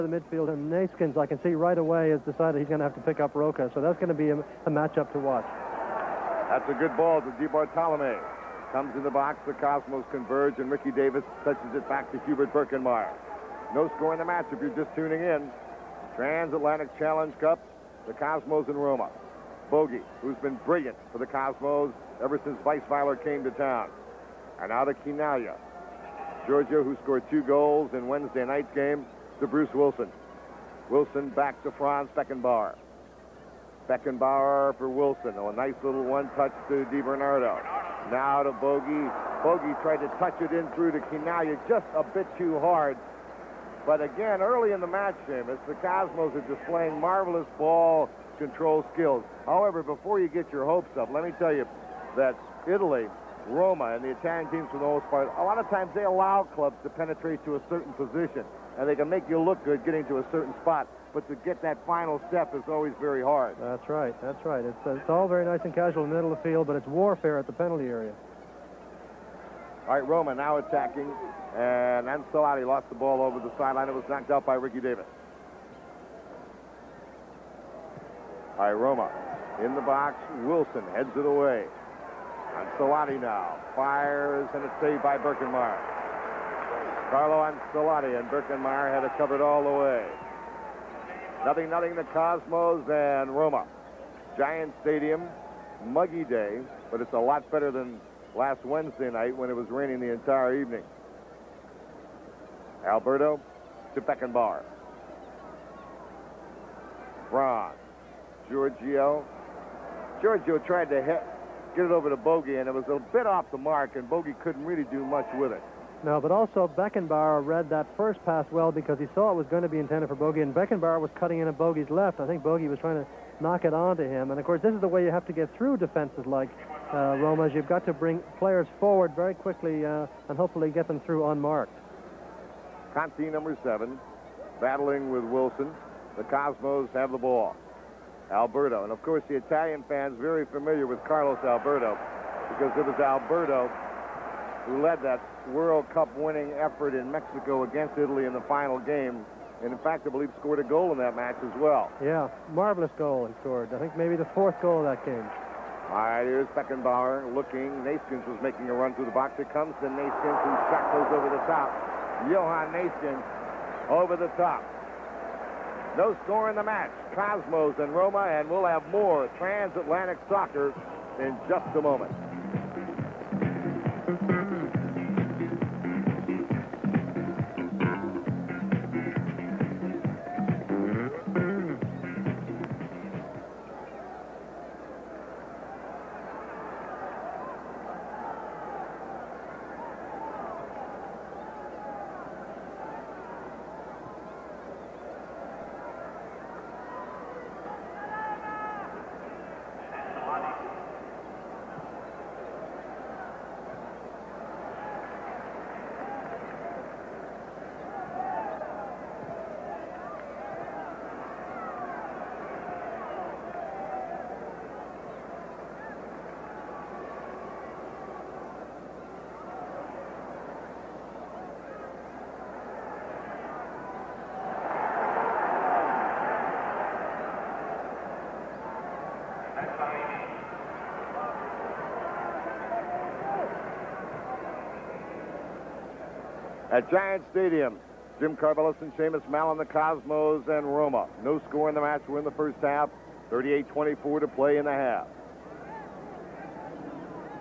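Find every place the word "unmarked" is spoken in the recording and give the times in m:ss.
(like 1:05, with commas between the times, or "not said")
2:11.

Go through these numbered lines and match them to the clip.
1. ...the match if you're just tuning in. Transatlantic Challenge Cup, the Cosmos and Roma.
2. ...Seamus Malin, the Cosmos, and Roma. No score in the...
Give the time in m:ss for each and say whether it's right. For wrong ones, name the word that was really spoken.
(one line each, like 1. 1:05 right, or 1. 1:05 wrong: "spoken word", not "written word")
1. 0:14 right
2. 3:58 right.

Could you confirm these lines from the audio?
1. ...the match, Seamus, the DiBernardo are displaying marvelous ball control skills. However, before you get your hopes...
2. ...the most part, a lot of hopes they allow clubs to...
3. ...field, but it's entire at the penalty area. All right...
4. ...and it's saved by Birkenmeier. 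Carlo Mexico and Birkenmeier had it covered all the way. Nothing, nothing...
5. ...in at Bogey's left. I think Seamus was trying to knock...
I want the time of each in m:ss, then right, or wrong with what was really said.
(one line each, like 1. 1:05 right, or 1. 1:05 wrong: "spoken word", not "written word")
1. 0:44 wrong: "Cosmos", not "DiBernardo"
2. 0:54 wrong: "times", not "hopes"
3. 1:06 wrong: "warfare", not "entire"
4. 1:24 wrong: "Ancelotti", not "Mexico"
5. 2:01 wrong: "Bogey", not "Seamus".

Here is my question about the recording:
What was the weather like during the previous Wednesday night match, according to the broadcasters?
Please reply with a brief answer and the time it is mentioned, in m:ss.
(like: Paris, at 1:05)
Raining, at 1:39.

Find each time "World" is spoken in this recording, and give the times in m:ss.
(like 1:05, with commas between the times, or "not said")
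2:25.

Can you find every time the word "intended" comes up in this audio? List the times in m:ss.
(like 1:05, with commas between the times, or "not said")
1:59.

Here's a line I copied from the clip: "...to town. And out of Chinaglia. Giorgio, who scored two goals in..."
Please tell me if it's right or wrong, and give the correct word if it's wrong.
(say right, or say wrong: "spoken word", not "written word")
right.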